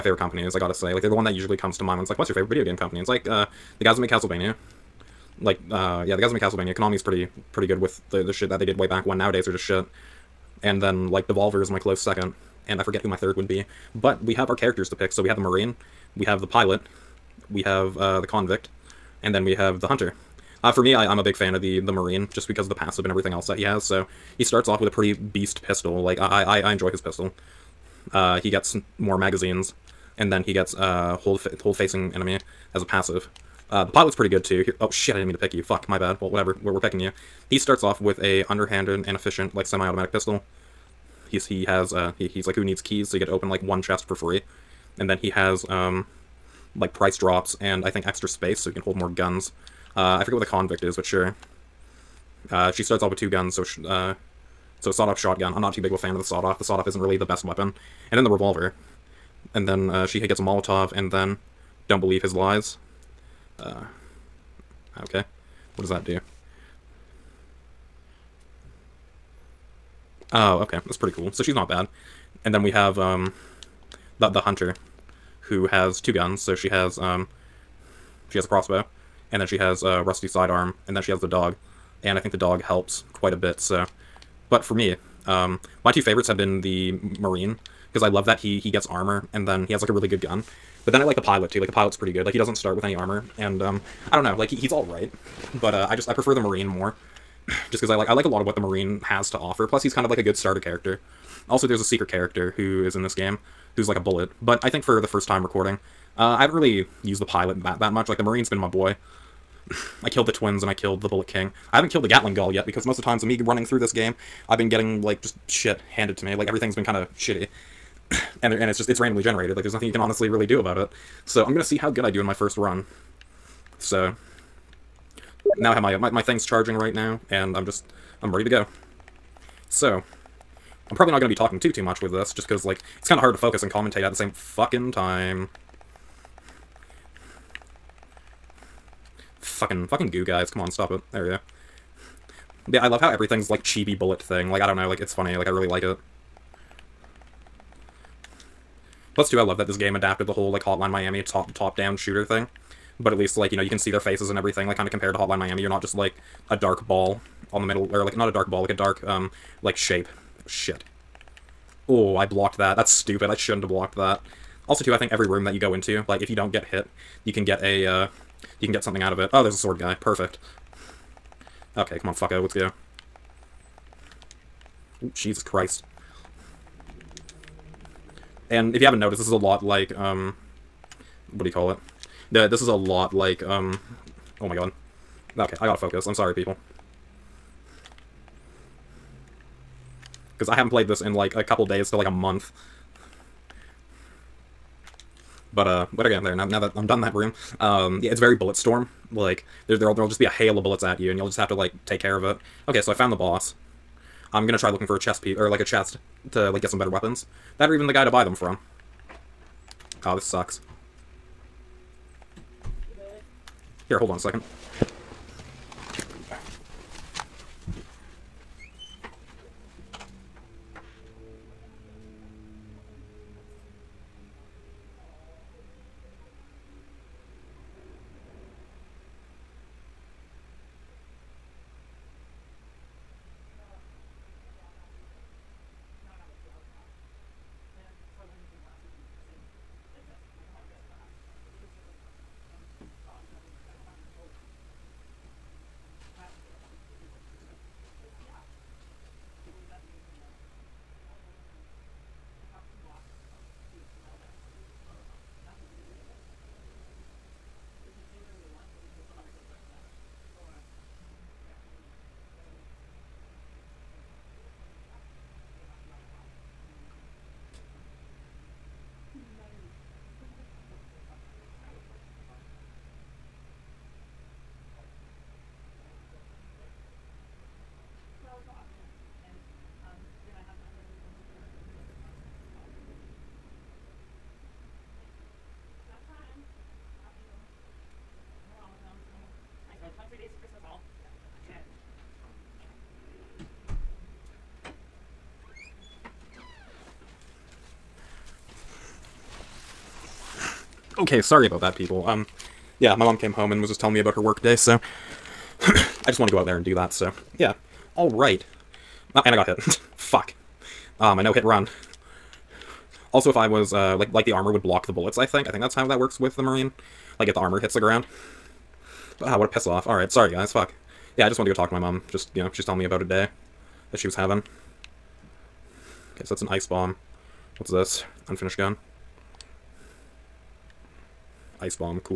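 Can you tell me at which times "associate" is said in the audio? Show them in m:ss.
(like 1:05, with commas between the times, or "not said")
not said.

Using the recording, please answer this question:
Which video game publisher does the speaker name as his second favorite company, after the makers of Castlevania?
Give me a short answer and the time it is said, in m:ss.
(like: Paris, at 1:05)
Devolver, at 0:11.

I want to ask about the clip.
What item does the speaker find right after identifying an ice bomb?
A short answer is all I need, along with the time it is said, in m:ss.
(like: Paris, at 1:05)
Unfinished gun, at 5:28.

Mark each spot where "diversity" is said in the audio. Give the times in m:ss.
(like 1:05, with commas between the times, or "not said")
not said.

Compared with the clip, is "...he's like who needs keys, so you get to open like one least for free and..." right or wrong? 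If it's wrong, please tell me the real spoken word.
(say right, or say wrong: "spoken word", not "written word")
wrong: "chest", not "least".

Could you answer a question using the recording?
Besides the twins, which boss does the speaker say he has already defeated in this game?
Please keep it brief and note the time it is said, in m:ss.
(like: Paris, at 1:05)
Bullet King, at 1:51.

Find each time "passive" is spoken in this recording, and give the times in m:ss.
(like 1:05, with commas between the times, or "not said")
0:22, 0:32.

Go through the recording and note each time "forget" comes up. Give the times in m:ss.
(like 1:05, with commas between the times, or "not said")
0:12, 0:50.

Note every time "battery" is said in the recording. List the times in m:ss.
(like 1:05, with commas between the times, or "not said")
not said.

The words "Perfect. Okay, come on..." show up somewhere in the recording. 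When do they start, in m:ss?
2:50.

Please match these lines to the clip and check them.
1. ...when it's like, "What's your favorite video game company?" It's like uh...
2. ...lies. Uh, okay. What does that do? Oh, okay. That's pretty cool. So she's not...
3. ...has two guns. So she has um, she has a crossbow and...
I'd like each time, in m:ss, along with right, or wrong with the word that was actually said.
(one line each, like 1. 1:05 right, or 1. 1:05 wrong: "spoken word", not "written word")
1. 0:01 right
2. 1:02 right
3. 1:15 right.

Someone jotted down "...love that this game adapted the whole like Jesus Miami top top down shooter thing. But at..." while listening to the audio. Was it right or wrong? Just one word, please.
wrong.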